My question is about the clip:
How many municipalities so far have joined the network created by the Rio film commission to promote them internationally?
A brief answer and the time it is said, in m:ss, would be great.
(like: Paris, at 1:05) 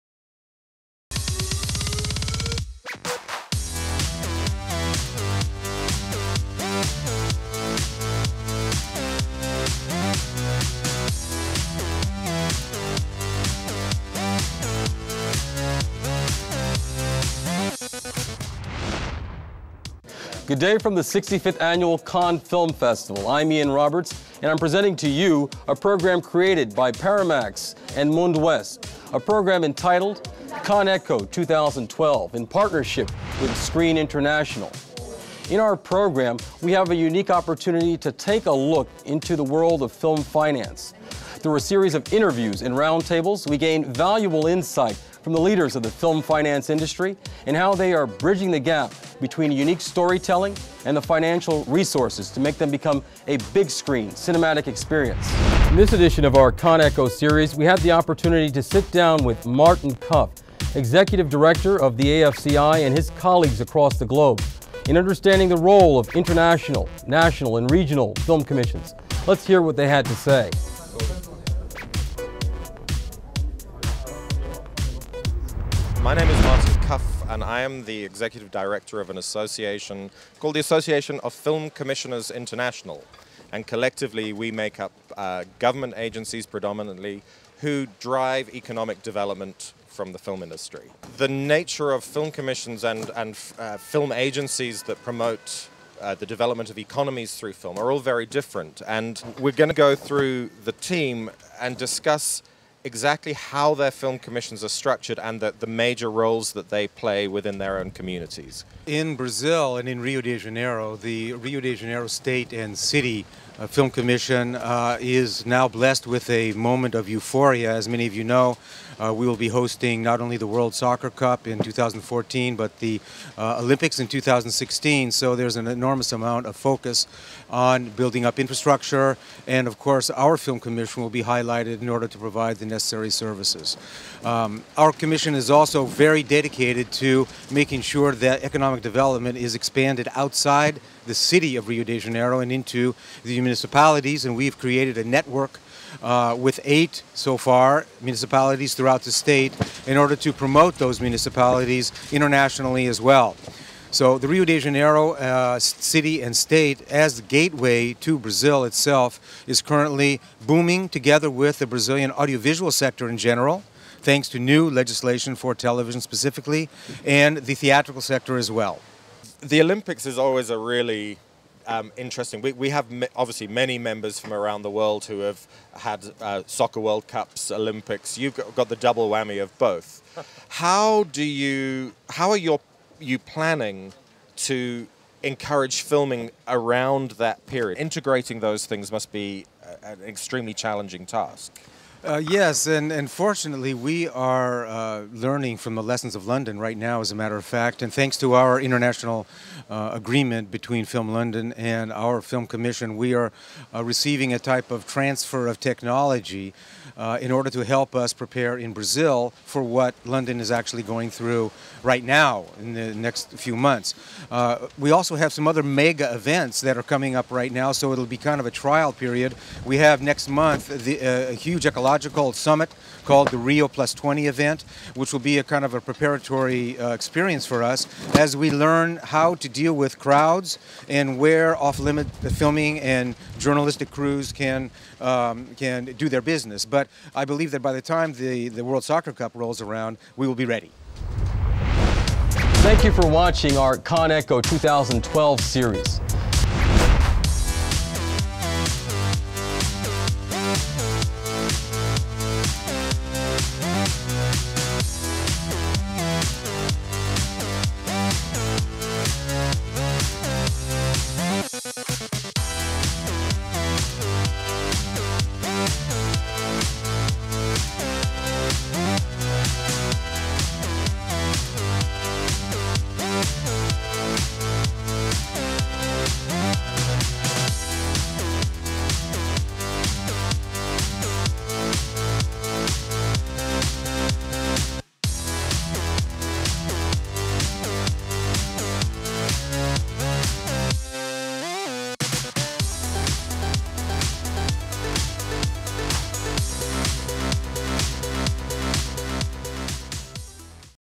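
8, at 2:26.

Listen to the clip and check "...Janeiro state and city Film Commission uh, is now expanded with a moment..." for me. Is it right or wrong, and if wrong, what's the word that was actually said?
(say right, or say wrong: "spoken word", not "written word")
wrong: "blessed", not "expanded".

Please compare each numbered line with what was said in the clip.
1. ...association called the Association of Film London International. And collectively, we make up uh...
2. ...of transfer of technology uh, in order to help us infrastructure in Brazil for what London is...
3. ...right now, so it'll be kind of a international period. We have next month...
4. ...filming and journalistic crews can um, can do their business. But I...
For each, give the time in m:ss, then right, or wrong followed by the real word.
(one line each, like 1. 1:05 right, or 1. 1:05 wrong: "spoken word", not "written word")
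1. 1:19 wrong: "Commissioners", not "London"
2. 3:24 wrong: "prepare", not "infrastructure"
3. 3:37 wrong: "trial", not "international"
4. 3:52 right.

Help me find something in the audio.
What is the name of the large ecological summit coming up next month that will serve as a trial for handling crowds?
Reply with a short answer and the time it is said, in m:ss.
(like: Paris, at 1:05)
Rio Plus 20, at 3:43.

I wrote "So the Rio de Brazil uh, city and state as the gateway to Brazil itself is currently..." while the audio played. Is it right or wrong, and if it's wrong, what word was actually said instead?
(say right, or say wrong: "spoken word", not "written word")
wrong: "Janeiro", not "Brazil".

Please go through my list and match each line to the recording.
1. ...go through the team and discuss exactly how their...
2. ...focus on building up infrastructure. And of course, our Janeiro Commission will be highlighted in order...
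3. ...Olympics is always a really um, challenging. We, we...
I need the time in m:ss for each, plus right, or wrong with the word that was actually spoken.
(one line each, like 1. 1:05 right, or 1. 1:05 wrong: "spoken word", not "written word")
1. 1:39 right
2. 2:06 wrong: "Film", not "Janeiro"
3. 2:49 wrong: "interesting", not "challenging".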